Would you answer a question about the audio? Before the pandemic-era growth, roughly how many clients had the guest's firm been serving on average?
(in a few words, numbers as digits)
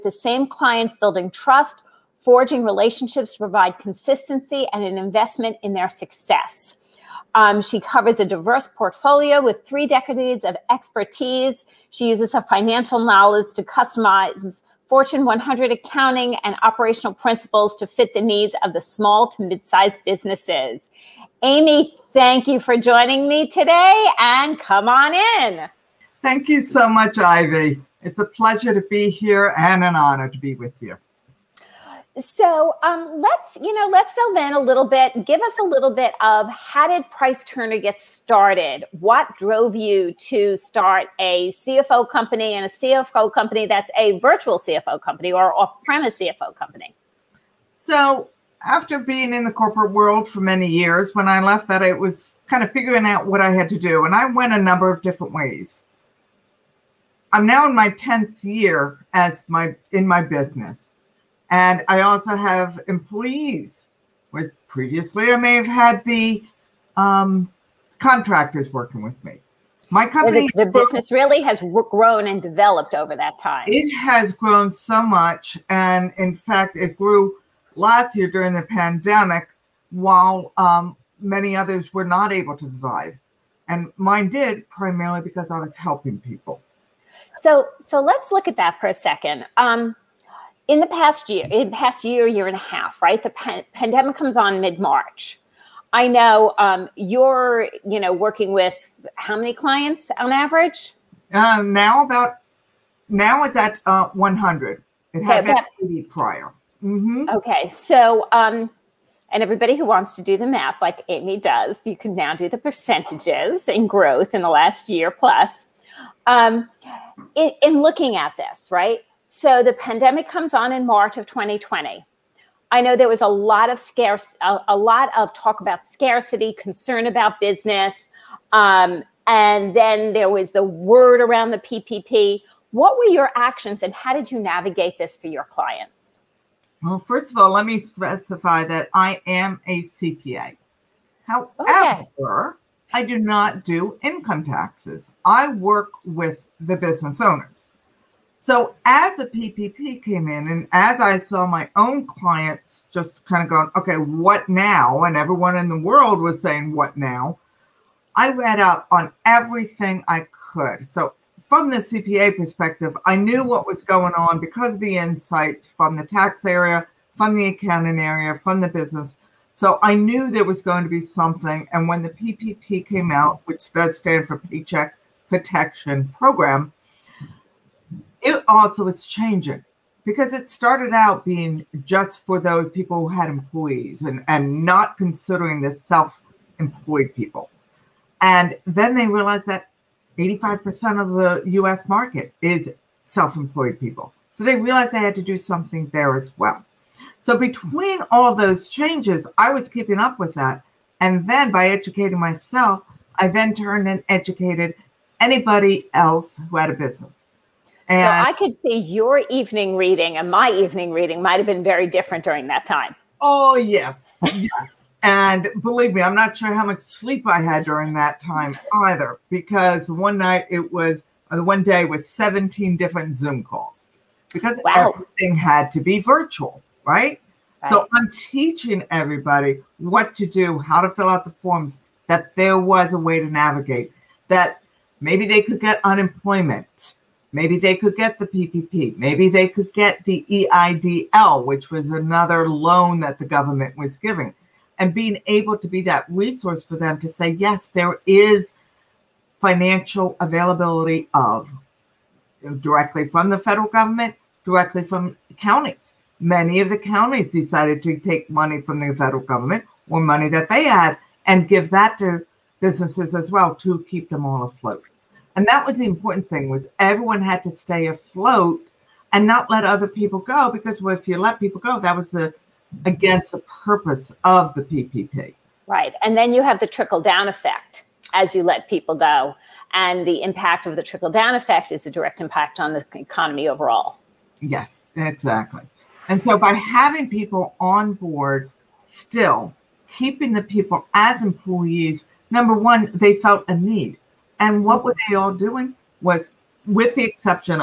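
80.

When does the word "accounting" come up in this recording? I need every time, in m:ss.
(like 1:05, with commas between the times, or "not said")
0:15, 2:47.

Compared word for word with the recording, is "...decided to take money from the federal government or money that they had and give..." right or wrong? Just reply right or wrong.
right.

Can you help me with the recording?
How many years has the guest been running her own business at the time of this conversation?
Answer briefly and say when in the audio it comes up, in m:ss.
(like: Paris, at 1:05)
10th year, at 0:57.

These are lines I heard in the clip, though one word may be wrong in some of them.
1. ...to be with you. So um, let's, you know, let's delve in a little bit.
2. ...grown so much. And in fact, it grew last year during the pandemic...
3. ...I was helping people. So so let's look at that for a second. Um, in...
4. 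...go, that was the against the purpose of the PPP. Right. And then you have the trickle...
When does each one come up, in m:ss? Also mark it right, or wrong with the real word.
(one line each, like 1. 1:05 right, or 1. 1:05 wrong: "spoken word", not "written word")
1. 0:30 right
2. 1:14 right
3. 1:25 right
4. 4:31 right.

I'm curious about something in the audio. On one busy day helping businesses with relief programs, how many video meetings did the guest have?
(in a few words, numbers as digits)
17.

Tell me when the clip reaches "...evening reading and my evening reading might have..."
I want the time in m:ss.
3:29.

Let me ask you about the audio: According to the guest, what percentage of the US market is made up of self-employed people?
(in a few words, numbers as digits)
85%.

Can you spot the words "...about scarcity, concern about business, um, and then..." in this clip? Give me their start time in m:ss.
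2:05.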